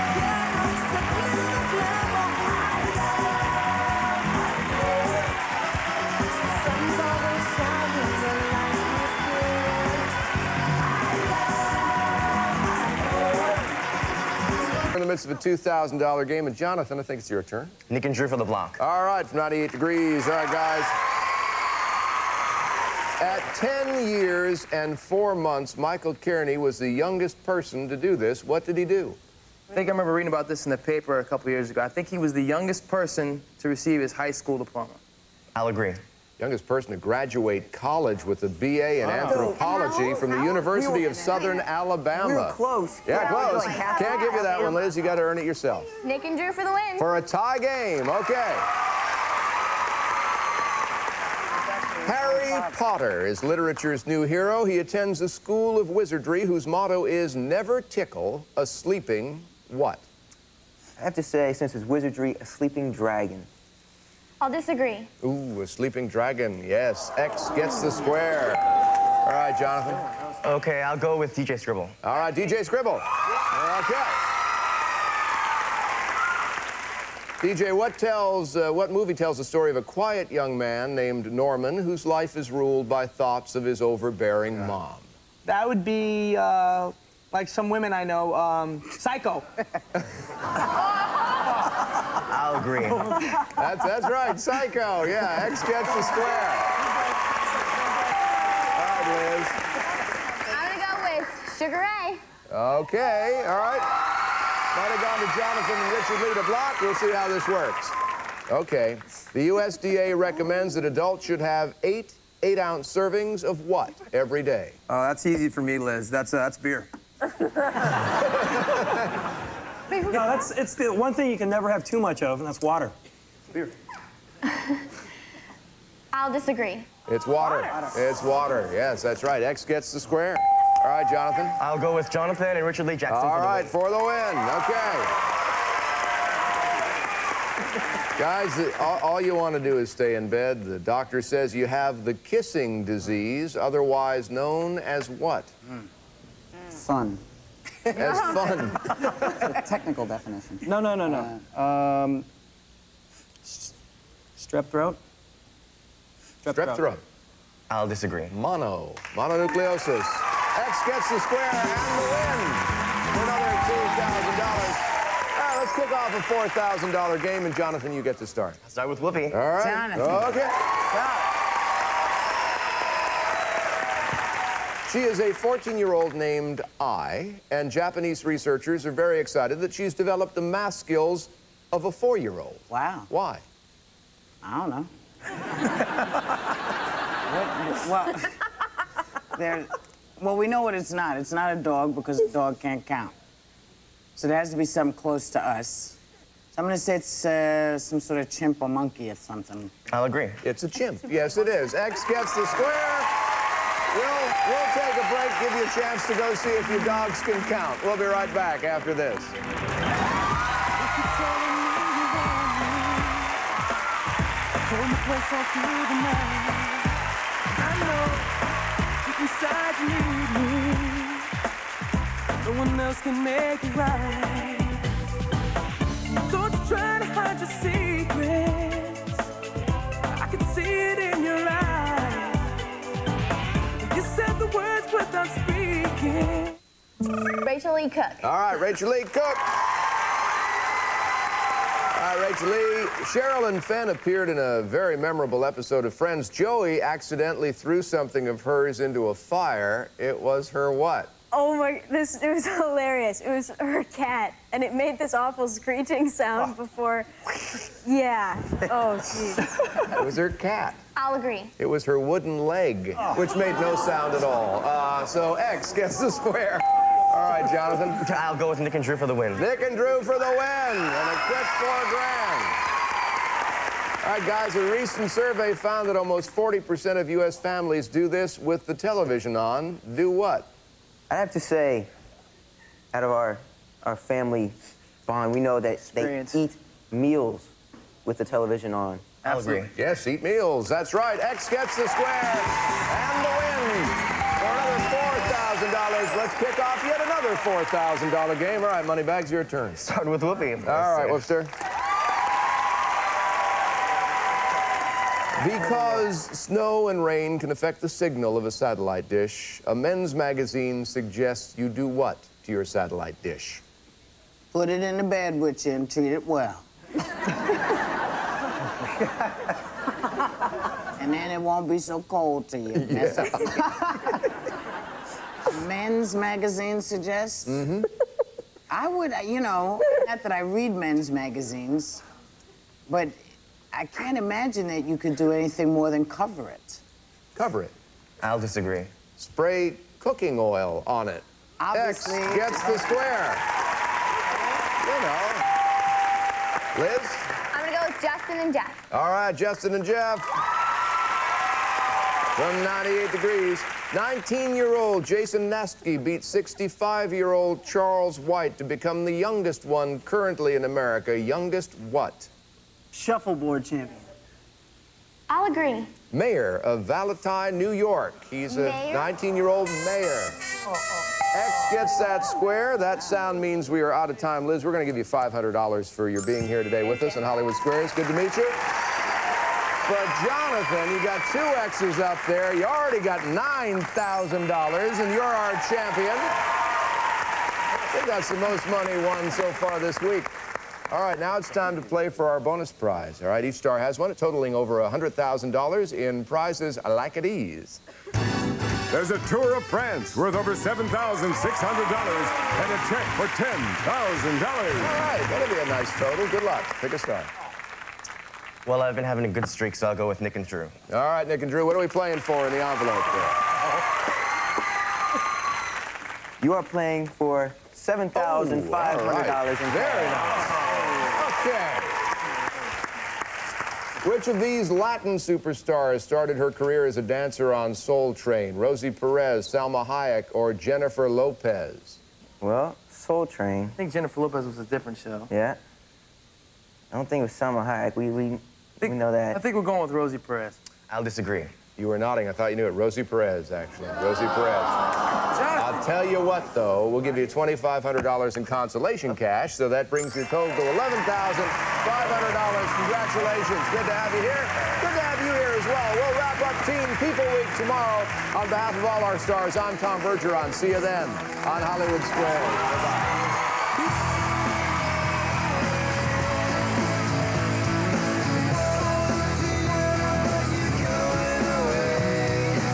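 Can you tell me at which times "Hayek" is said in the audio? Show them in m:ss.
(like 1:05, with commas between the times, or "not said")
7:09, 7:17.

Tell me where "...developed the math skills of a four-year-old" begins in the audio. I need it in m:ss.
2:59.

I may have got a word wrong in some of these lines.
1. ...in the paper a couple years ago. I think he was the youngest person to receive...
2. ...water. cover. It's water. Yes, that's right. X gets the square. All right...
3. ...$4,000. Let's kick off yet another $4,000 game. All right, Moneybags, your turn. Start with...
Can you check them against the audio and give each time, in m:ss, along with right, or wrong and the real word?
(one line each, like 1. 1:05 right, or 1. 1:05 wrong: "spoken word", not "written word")
1. 0:30 right
2. 2:07 wrong: "water", not "cover"
3. 4:55 right.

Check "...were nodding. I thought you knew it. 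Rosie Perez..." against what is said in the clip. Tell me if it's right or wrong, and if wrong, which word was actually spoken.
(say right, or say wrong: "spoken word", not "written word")
right.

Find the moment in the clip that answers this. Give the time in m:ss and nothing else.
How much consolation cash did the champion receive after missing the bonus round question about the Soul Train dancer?
7:27.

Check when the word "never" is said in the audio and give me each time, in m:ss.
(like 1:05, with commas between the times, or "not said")
0:57, 2:01.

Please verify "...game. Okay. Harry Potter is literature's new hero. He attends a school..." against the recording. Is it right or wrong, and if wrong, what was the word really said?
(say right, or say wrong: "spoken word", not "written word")
right.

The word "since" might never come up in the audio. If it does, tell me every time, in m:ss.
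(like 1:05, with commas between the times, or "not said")
1:01.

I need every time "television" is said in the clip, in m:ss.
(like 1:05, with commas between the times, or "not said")
4:38, 4:48.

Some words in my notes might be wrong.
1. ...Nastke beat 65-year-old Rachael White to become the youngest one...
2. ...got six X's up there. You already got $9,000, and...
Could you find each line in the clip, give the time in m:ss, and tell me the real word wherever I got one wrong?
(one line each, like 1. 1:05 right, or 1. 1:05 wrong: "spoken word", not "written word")
1. 5:55 wrong: "Charles", not "Rachael"
2. 6:21 wrong: "two", not "six".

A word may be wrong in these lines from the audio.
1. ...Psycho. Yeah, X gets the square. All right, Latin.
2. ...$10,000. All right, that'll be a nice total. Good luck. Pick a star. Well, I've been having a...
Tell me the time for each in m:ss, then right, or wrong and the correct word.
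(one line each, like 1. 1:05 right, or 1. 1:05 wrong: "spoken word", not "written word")
1. 1:34 wrong: "Liz", not "Latin"
2. 6:43 right.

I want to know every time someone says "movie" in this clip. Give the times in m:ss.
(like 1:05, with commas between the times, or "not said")
1:18.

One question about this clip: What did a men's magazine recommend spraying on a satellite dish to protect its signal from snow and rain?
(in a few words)
cooking oil.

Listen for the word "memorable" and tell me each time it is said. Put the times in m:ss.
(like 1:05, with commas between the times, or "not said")
4:04.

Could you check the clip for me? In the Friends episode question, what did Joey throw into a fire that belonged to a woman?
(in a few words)
wooden leg.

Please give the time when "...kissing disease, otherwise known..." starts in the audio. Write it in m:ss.
2:22.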